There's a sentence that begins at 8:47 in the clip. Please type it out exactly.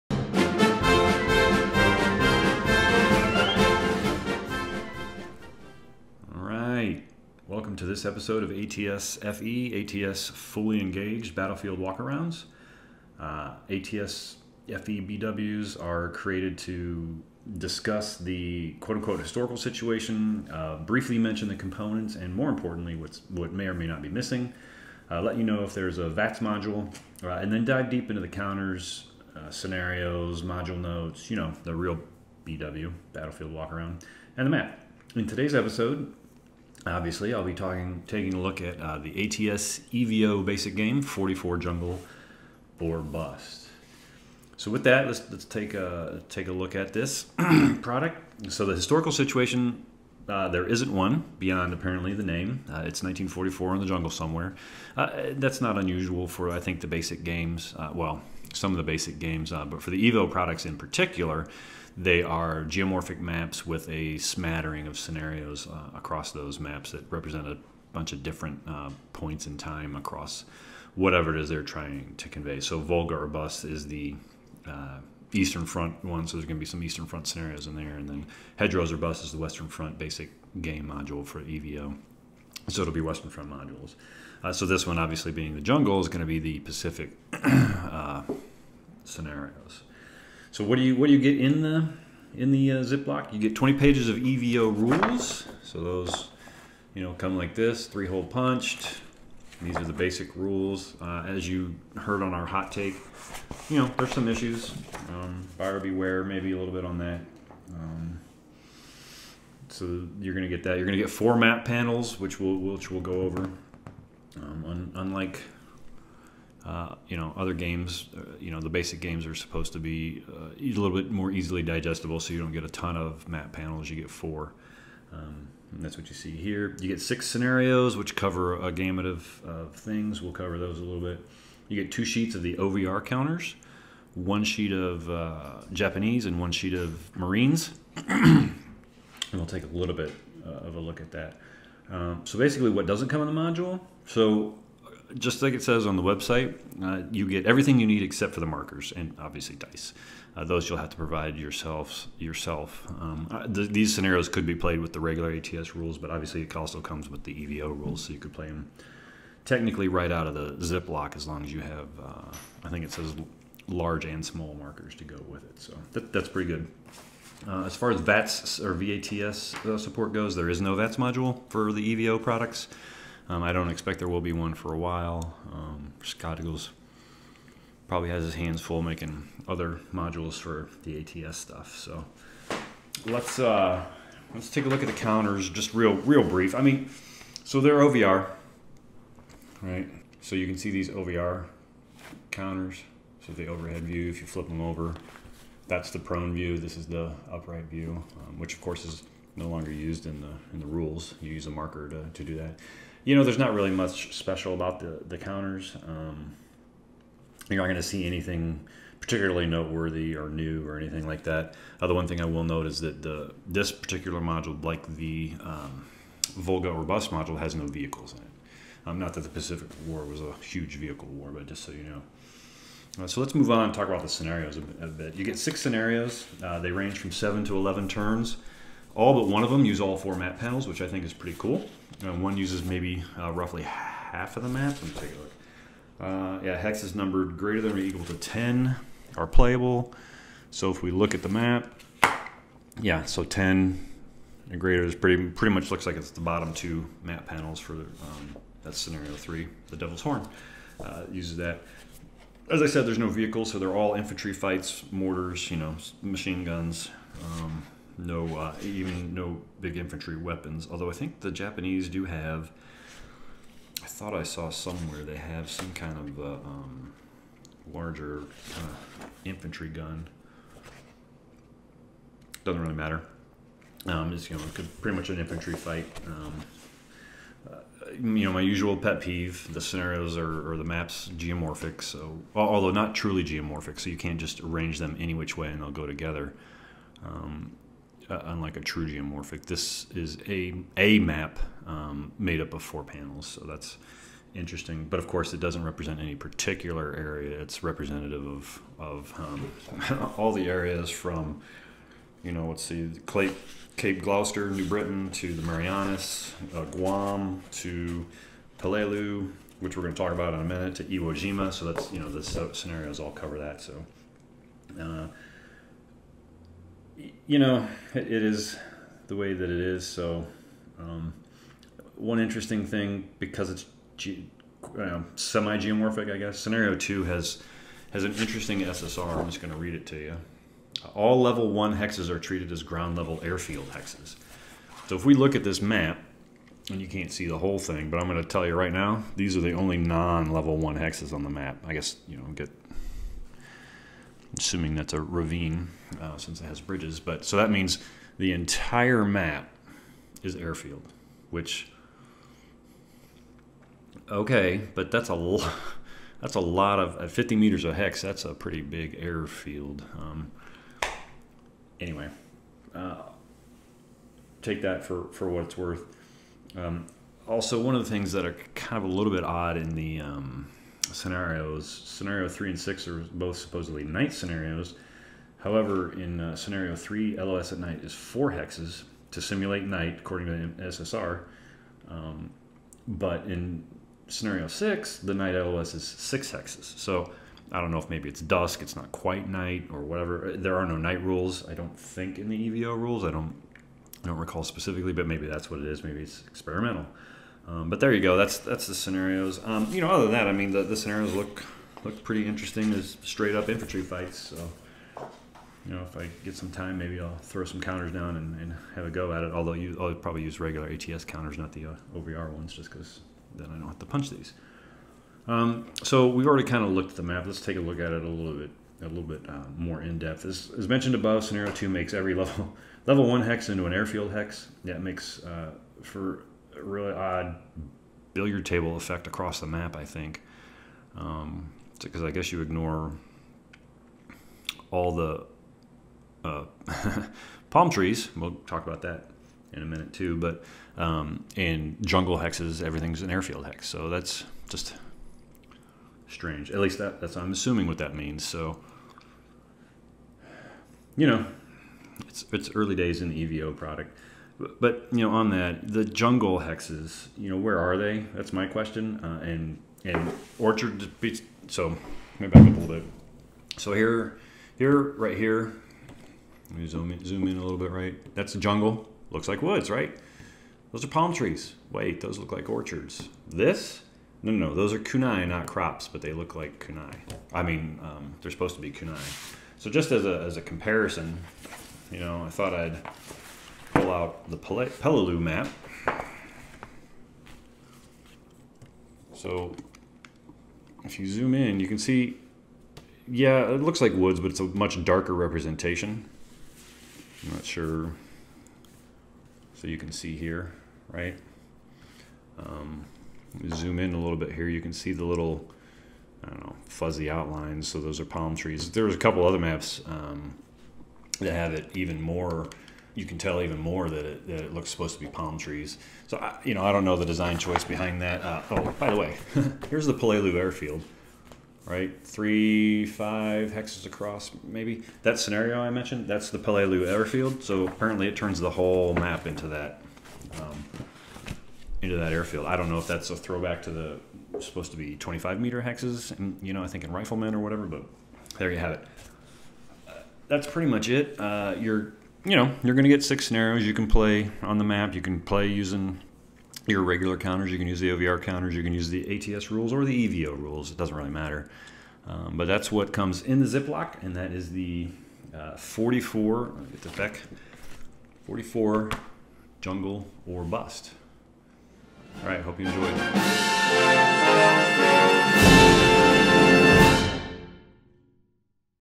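So apparently it turns the whole map into that, um, into that airfield.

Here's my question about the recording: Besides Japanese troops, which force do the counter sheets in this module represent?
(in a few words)
Marines.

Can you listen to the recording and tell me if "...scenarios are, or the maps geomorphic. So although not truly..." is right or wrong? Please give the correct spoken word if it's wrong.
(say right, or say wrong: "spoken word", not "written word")
right.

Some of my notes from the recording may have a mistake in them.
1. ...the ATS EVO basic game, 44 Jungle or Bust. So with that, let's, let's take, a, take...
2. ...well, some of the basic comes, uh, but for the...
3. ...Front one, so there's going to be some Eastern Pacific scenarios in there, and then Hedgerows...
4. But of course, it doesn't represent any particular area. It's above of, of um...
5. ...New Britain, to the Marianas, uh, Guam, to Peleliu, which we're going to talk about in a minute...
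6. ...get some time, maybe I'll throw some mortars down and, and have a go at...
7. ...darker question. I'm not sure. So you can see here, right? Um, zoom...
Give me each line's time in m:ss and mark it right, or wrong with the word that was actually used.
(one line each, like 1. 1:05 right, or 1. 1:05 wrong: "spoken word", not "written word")
1. 0:38 right
2. 0:57 wrong: "games", not "comes"
3. 1:15 wrong: "Front", not "Pacific"
4. 4:54 wrong: "representative", not "above"
5. 5:04 right
6. 6:46 wrong: "counters", not "mortars"
7. 8:14 wrong: "representation", not "question".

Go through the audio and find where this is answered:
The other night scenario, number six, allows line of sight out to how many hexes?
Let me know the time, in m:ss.
6:25.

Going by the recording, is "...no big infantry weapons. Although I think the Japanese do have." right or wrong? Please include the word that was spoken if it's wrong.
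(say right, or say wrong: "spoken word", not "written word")
right.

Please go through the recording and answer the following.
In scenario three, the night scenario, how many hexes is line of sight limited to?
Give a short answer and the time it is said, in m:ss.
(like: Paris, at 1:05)
4, at 6:17.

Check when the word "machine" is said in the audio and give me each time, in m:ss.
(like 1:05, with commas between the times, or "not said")
4:16.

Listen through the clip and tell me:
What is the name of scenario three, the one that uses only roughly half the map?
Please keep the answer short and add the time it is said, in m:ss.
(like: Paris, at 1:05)
The Devil's Horn, at 4:09.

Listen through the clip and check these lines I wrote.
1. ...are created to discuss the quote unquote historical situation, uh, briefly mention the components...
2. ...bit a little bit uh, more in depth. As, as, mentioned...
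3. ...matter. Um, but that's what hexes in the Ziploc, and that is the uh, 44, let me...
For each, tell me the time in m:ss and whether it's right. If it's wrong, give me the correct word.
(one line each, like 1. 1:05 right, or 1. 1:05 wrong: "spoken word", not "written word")
1. 0:15 right
2. 6:58 right
3. 9:11 wrong: "comes", not "hexes".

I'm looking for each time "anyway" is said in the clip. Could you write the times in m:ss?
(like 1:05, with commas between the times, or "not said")
6:01.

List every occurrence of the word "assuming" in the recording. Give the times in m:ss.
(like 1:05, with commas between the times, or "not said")
5:44, 7:27.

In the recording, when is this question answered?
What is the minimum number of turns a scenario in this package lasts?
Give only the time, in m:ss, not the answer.
3:47.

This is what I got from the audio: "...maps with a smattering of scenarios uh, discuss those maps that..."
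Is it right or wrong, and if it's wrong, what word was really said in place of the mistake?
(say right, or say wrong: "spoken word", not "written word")
wrong: "across", not "discuss".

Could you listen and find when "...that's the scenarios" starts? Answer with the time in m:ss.
6:38.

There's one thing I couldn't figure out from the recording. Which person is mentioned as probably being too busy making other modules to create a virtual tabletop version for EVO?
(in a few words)
Scott Eagles.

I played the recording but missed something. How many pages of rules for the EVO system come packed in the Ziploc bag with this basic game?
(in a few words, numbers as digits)
20.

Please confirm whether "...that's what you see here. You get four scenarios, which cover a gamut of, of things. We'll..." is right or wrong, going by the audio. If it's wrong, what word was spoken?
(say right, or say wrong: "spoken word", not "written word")
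wrong: "six", not "four".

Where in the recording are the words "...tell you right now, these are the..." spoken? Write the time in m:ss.
5:38.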